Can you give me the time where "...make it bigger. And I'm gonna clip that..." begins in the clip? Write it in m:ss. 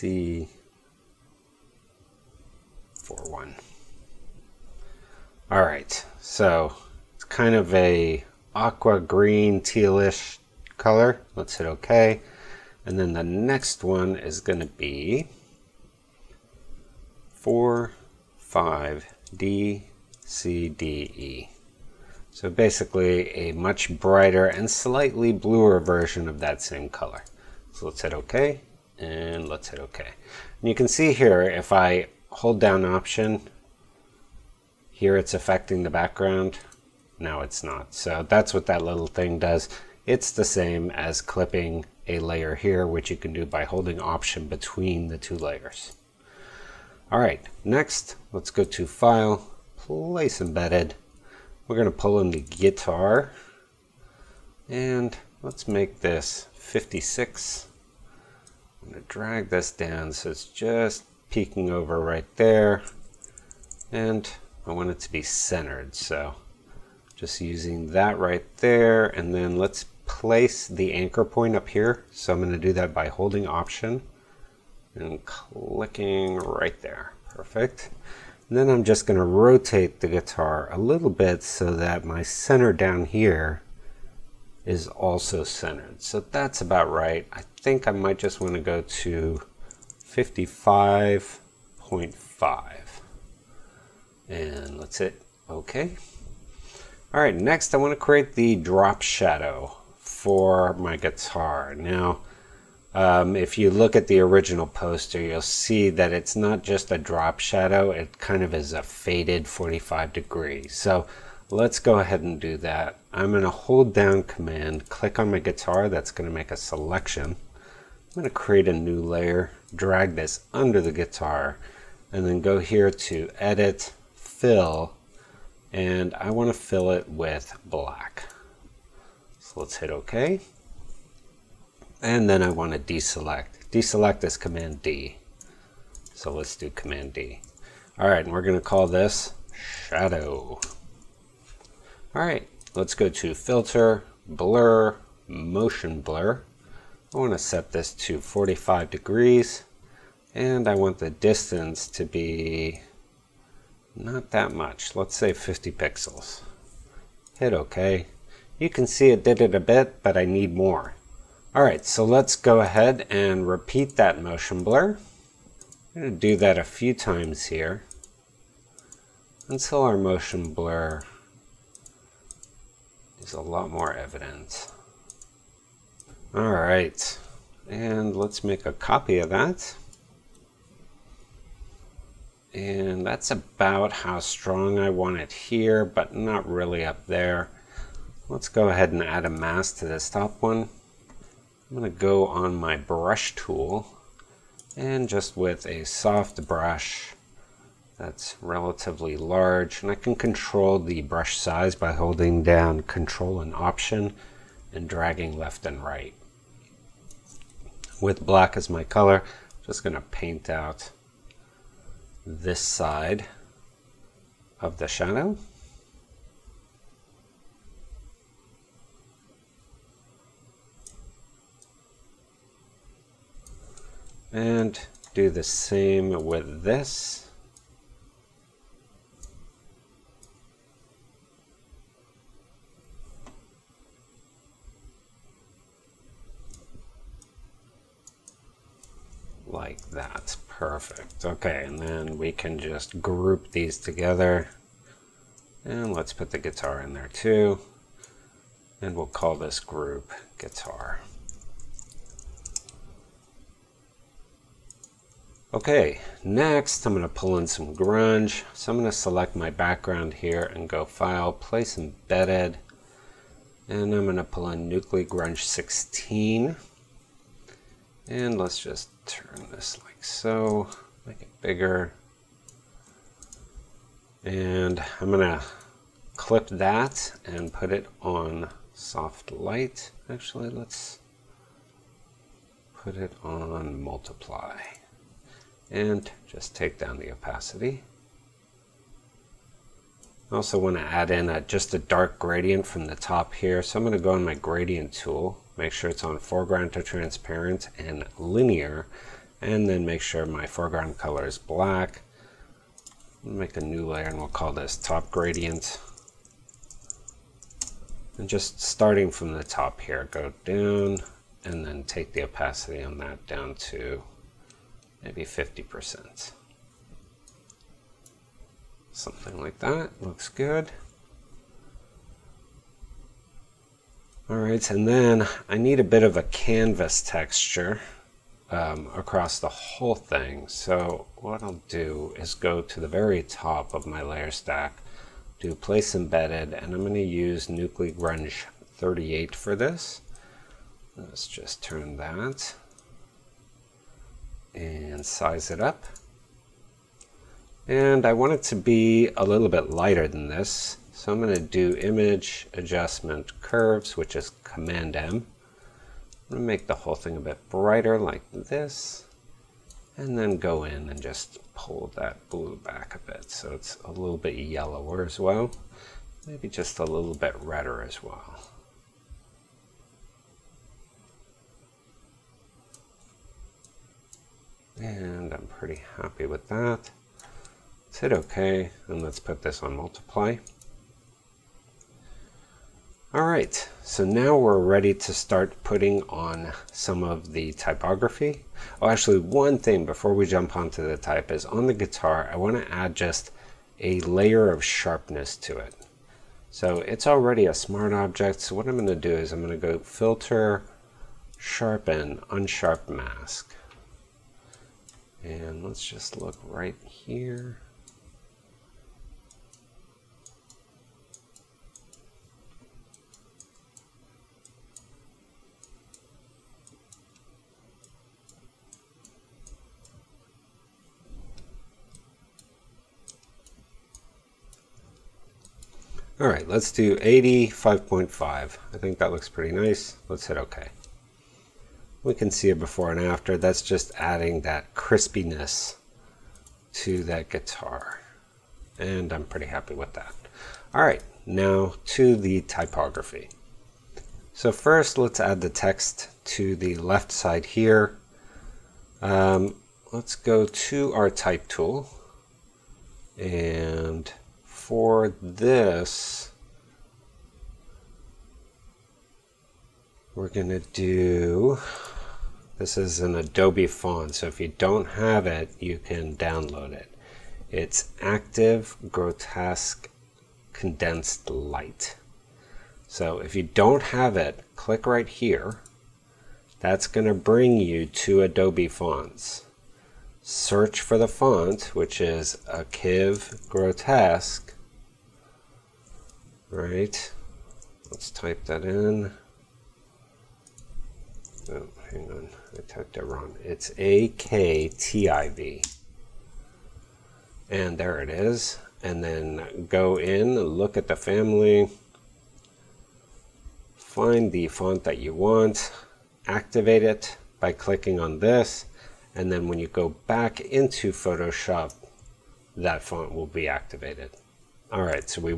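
4:31.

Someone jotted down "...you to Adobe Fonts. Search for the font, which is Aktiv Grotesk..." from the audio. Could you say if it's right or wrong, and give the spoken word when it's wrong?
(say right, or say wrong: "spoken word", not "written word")
right.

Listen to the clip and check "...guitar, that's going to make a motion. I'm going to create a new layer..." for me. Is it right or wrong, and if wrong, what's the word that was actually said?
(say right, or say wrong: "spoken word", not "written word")
wrong: "selection", not "motion".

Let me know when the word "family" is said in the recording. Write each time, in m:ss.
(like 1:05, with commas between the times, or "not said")
8:20.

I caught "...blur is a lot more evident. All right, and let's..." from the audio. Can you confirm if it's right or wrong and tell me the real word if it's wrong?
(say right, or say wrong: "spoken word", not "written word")
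right.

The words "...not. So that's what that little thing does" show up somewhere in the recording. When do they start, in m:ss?
0:37.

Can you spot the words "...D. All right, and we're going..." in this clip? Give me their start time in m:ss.
2:17.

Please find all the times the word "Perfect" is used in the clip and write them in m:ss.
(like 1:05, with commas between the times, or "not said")
1:17, 4:00.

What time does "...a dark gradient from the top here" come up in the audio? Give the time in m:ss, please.
4:51.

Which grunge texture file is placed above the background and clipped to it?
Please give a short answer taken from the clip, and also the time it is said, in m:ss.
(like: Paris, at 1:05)
Nucly Grunge 16, at 4:24.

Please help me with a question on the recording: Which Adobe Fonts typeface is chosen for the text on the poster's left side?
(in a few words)
Aktiv Grotesk Condensed Light.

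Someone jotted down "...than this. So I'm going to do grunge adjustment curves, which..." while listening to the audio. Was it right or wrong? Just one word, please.
wrong.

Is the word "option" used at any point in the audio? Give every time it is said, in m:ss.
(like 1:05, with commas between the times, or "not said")
0:32, 0:43, 1:13, 3:23.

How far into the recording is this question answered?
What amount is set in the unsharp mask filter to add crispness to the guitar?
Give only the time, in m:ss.
7:06.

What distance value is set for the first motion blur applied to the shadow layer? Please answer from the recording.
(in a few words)
50 pixels.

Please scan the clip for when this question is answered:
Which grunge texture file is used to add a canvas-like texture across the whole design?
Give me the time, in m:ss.
5:37.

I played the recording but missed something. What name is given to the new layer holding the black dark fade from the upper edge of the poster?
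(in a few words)
top gradient.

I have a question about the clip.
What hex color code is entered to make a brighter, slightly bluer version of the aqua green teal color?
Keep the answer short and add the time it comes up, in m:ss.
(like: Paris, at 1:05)
45DCDE, at 0:17.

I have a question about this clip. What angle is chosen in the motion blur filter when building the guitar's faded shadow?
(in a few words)
45 degrees.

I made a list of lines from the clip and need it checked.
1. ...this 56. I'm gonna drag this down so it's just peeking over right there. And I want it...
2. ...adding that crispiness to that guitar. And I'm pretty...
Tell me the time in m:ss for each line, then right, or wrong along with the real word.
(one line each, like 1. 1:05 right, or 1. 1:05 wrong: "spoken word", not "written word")
1. 0:56 right
2. 7:13 right.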